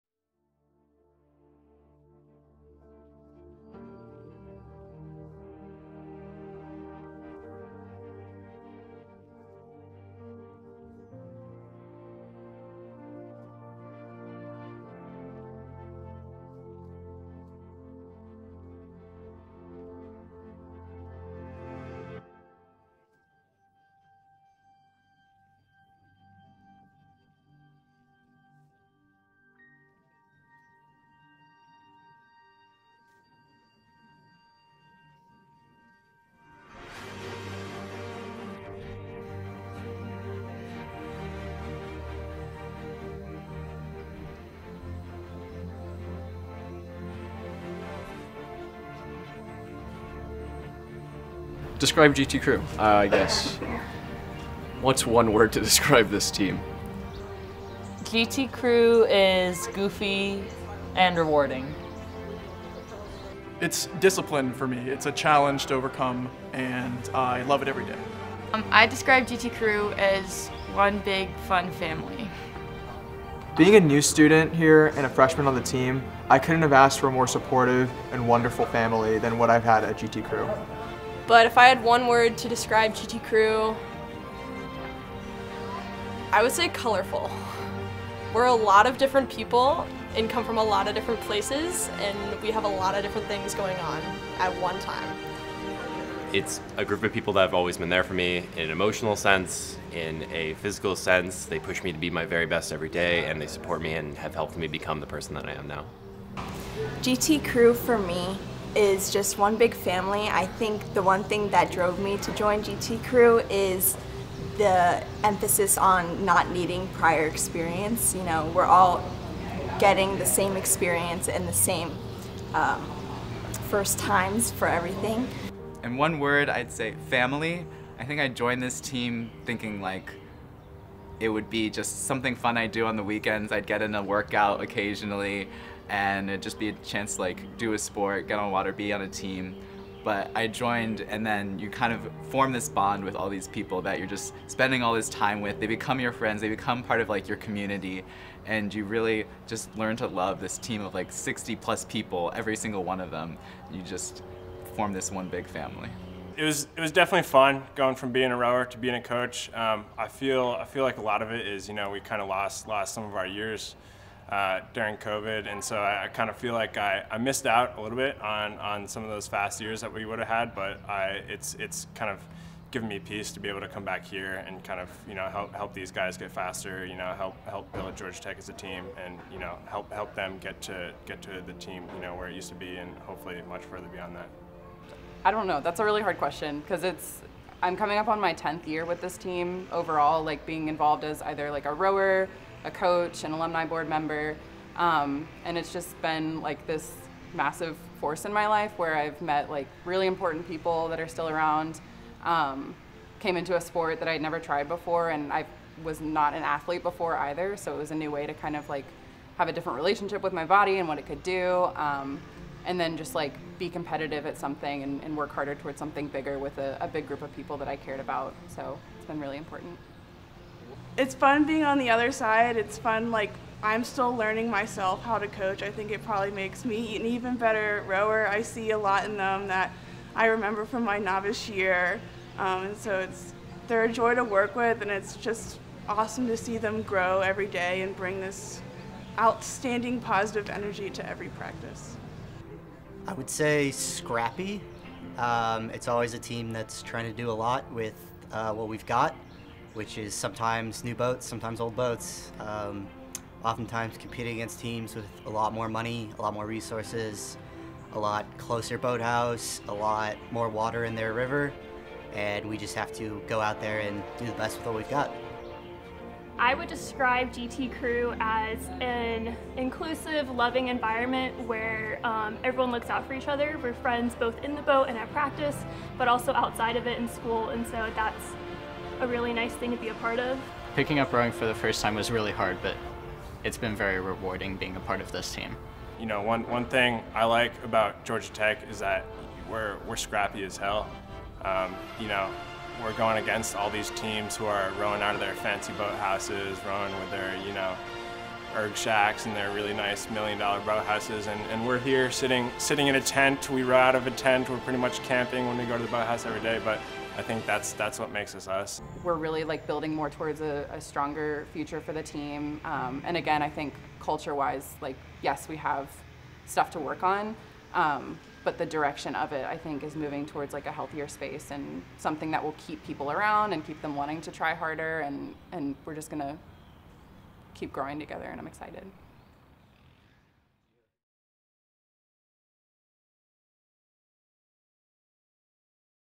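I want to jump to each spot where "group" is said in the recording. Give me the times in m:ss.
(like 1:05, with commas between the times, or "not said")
1:36, 3:37.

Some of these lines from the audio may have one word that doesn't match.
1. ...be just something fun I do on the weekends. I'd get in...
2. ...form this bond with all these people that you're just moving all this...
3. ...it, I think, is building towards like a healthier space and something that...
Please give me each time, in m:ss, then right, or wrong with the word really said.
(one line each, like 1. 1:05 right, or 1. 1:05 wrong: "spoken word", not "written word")
1. 2:11 right
2. 2:22 wrong: "spending", not "moving"
3. 5:19 wrong: "moving", not "building".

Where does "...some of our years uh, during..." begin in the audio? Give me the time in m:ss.
2:42.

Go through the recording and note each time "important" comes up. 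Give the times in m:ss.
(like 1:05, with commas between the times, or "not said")
3:20, 3:39.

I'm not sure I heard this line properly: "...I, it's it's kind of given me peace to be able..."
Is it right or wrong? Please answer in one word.
right.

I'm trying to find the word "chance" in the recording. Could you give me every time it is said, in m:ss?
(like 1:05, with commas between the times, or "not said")
2:16.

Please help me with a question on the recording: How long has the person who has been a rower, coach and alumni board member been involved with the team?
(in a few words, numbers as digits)
10th year.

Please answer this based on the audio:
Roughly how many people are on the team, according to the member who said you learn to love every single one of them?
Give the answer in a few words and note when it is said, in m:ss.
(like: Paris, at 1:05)
60 plus, at 2:31.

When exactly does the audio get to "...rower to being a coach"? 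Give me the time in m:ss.
2:38.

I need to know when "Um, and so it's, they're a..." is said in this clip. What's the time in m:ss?
3:52.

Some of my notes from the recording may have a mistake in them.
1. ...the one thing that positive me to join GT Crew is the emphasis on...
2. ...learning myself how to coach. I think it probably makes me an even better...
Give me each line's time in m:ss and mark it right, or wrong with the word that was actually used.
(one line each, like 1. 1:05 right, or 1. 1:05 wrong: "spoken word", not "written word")
1. 1:50 wrong: "drove", not "positive"
2. 3:44 right.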